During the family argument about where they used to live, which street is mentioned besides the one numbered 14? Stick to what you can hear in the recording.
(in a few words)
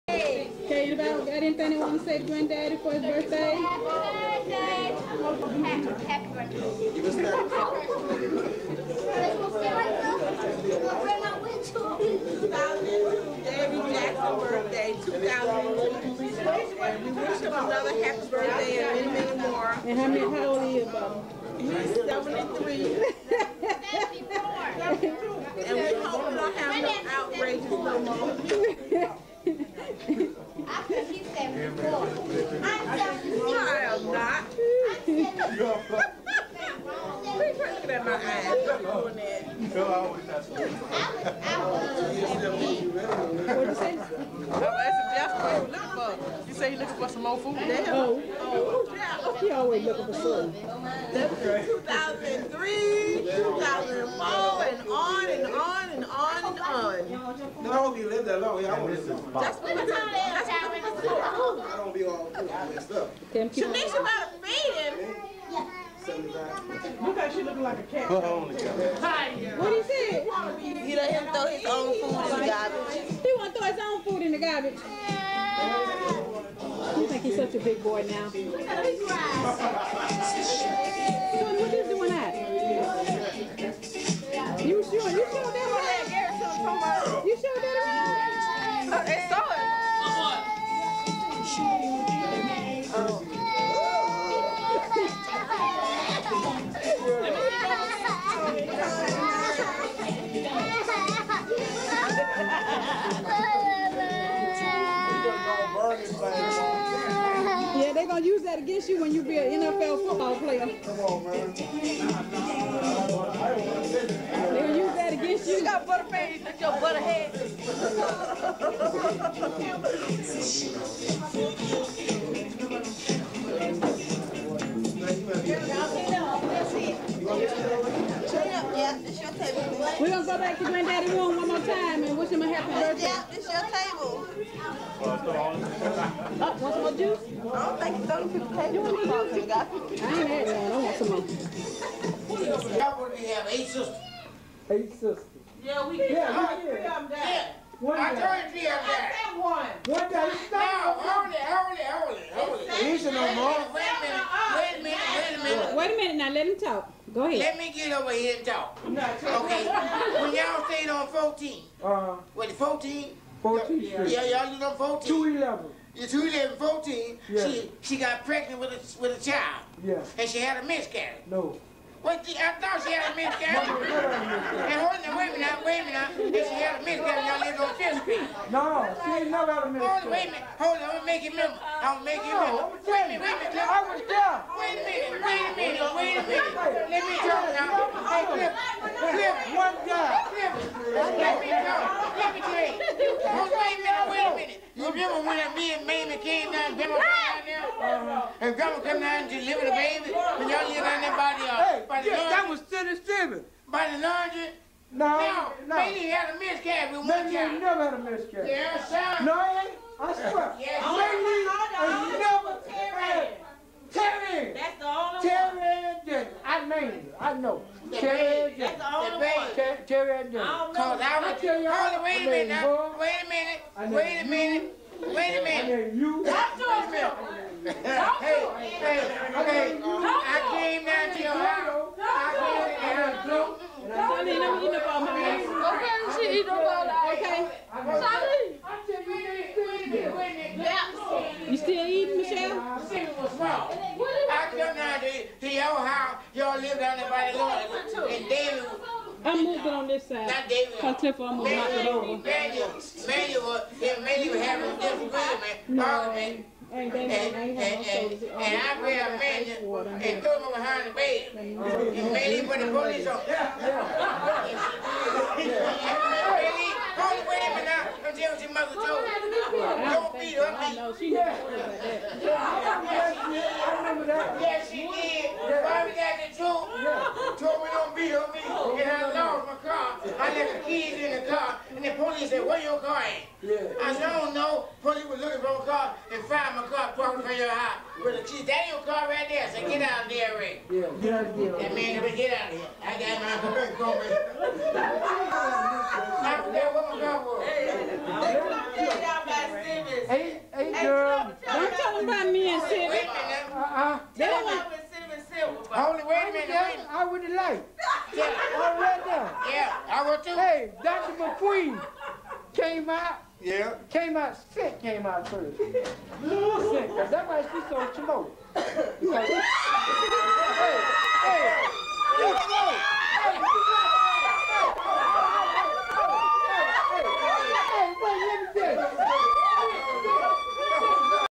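Fifth Street.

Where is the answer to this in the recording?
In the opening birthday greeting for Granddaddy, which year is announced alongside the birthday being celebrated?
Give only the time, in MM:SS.
00:15.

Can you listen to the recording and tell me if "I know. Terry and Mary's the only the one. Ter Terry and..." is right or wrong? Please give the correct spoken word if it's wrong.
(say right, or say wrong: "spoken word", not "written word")
wrong: "That", not "Mary".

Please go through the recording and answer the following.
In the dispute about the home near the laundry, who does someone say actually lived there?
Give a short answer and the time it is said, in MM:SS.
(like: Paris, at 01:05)
Sidney Stevens, at 03:22.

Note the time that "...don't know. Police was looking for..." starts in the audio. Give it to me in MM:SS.
04:44.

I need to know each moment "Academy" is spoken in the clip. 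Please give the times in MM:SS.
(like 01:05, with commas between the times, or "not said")
not said.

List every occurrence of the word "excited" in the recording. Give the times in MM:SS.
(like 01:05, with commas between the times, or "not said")
00:00.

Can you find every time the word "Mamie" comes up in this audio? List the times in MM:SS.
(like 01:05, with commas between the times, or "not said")
03:15, 03:25, 03:30.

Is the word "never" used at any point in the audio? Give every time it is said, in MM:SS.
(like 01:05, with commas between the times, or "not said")
02:59, 03:27, 03:32.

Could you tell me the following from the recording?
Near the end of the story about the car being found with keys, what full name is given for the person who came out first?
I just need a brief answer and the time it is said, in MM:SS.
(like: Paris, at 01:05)
Patrick McQueen, at 05:11.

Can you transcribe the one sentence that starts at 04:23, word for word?
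Mandy, hold with him and I'm tell your mother told Don't beat her.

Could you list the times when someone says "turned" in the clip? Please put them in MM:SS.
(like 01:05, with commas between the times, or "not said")
02:28.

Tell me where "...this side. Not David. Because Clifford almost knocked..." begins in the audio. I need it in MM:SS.
04:09.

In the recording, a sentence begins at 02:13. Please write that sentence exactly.
Yeah, this your table want some more juice?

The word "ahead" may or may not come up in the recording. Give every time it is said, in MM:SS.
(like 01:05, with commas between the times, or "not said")
02:37.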